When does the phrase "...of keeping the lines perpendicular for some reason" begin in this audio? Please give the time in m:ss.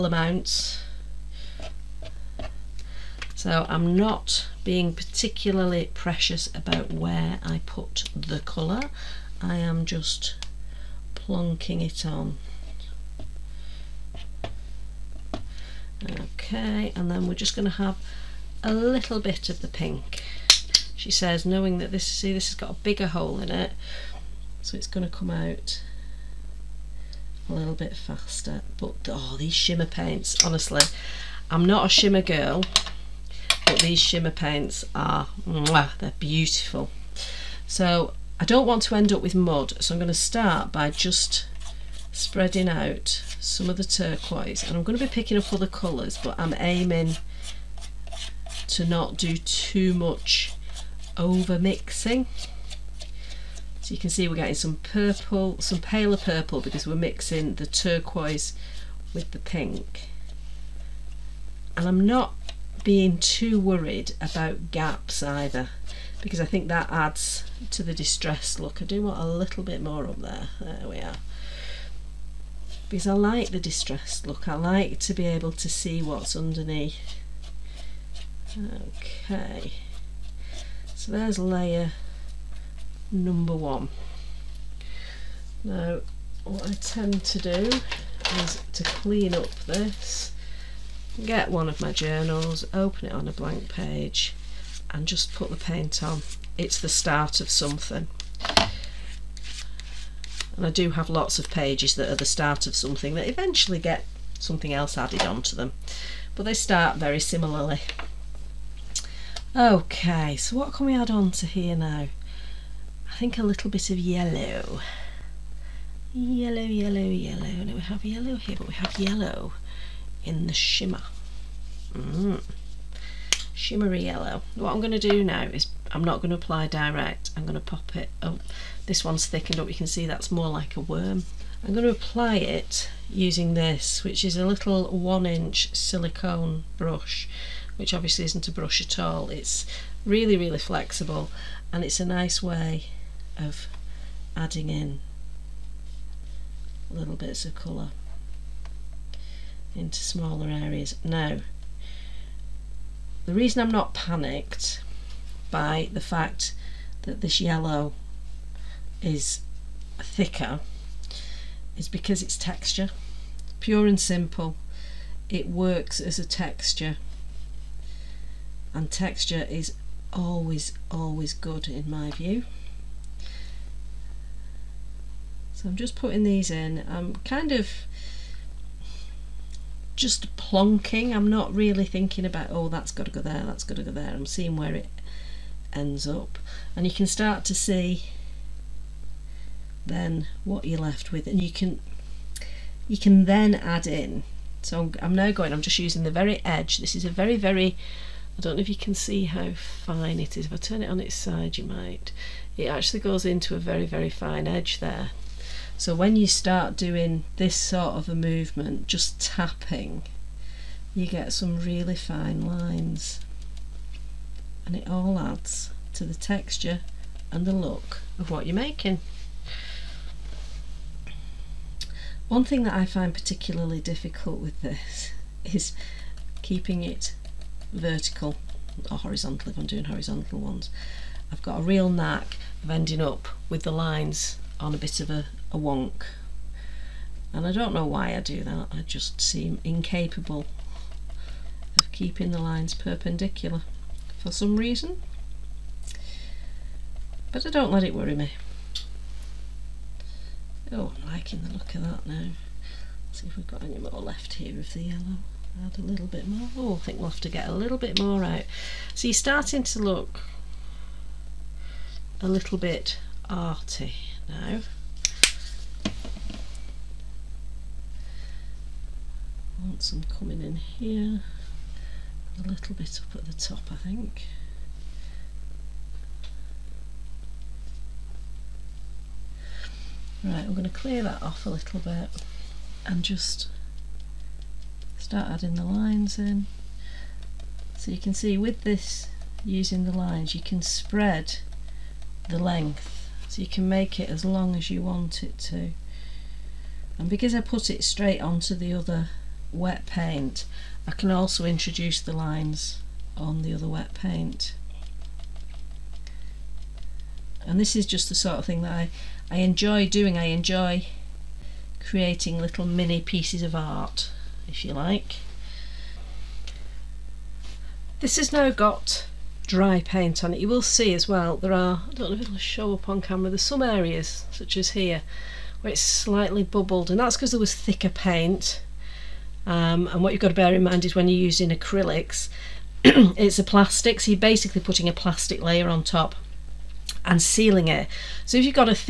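4:01.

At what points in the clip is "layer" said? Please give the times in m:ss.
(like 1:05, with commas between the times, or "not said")
1:21, 5:35.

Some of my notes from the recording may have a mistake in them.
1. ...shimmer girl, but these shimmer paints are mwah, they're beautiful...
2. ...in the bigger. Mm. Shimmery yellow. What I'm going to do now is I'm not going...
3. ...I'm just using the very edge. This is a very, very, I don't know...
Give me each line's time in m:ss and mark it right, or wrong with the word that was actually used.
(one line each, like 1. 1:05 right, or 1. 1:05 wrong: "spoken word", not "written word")
1. 0:31 right
2. 2:00 wrong: "shimmer", not "bigger"
3. 3:15 right.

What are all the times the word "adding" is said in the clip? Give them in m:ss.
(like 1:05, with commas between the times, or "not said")
2:24, 4:45.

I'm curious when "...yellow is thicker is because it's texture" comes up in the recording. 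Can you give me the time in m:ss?
2:37.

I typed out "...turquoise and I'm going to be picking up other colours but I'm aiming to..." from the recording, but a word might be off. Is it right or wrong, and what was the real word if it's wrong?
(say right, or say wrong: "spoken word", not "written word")
right.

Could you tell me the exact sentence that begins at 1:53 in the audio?
I think a little bit of yellow.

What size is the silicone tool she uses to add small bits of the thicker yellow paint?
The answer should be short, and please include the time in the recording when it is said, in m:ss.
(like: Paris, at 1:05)
1 inch, at 2:14.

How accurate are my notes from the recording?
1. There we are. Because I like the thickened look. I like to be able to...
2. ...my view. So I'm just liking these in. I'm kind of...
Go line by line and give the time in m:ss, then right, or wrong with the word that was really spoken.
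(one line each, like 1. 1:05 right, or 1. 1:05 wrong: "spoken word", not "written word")
1. 1:10 wrong: "distressed", not "thickened"
2. 2:51 wrong: "putting", not "liking".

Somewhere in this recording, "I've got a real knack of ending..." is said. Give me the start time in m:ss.
3:51.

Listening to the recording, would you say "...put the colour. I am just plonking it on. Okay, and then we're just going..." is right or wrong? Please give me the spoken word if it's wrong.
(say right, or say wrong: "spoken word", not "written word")
right.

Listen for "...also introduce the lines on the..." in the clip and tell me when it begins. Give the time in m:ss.
5:01.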